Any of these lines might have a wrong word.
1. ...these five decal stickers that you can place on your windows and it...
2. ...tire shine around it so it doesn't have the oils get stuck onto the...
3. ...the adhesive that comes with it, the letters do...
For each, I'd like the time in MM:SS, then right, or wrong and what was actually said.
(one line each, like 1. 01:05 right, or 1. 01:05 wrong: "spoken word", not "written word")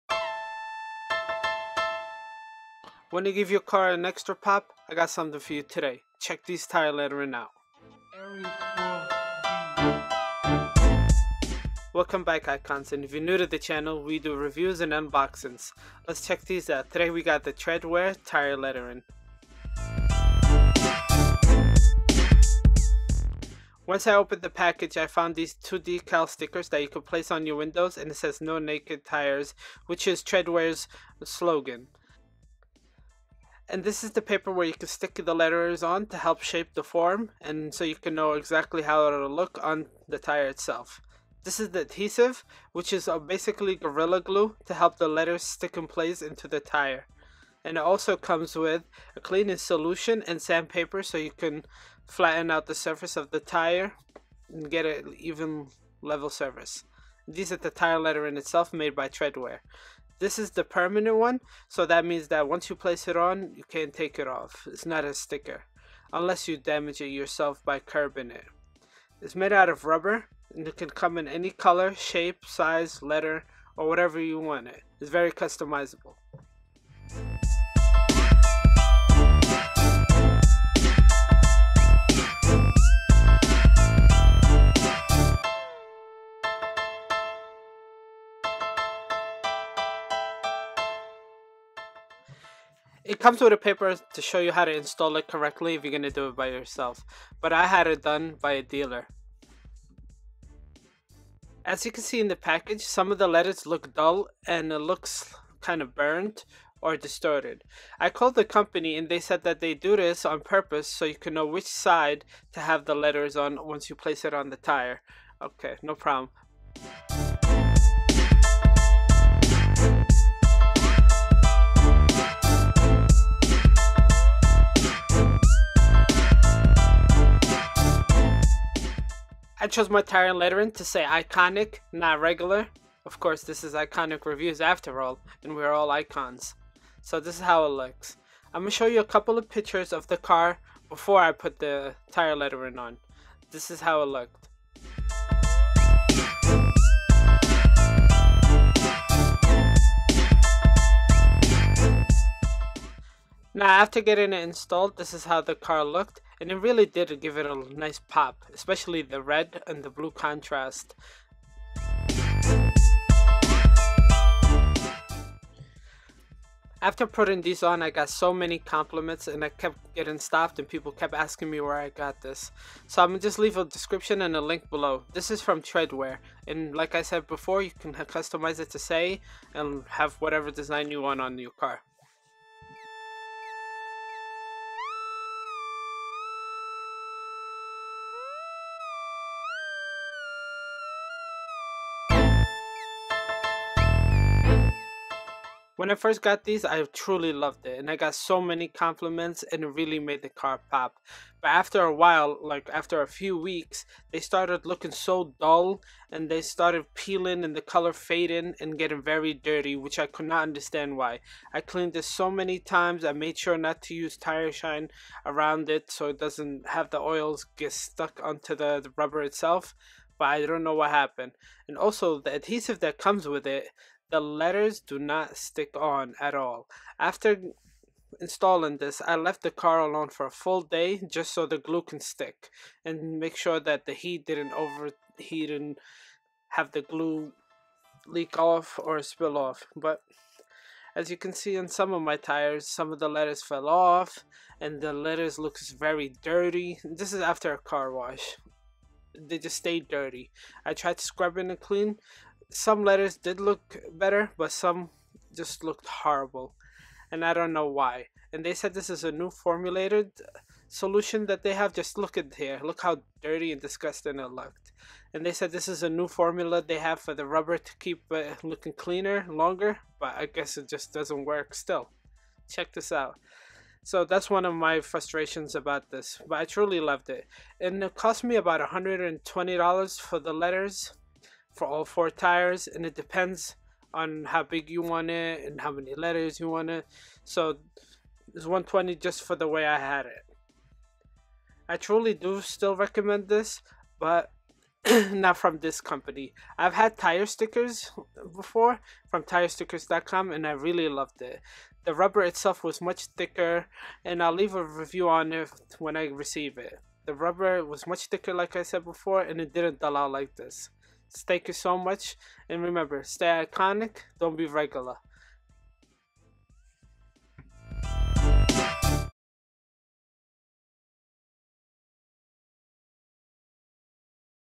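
1. 00:25 wrong: "two", not "five"
2. 03:34 right
3. 03:42 right.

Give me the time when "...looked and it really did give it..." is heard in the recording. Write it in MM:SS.
02:35.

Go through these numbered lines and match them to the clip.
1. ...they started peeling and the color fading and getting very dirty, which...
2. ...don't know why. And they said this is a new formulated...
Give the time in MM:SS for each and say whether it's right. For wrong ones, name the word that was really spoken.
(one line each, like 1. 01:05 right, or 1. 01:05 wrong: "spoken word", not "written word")
1. 03:26 right
2. 04:17 right.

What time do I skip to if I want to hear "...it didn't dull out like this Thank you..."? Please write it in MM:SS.
05:09.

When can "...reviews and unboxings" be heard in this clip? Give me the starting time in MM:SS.
00:14.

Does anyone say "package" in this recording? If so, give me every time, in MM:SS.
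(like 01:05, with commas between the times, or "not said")
00:24, 01:42.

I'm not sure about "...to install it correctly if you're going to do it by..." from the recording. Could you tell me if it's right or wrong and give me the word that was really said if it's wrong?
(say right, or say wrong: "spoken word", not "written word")
right.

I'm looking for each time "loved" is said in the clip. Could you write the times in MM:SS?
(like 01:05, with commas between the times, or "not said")
03:17, 04:36, 05:00.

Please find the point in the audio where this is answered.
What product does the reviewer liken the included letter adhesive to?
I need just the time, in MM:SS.
00:43.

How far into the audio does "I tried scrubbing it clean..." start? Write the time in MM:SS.
04:10.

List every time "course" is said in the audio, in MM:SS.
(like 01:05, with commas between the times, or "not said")
02:13.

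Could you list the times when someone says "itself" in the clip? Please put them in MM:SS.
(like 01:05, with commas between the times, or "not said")
00:40, 00:58, 03:39, 05:02.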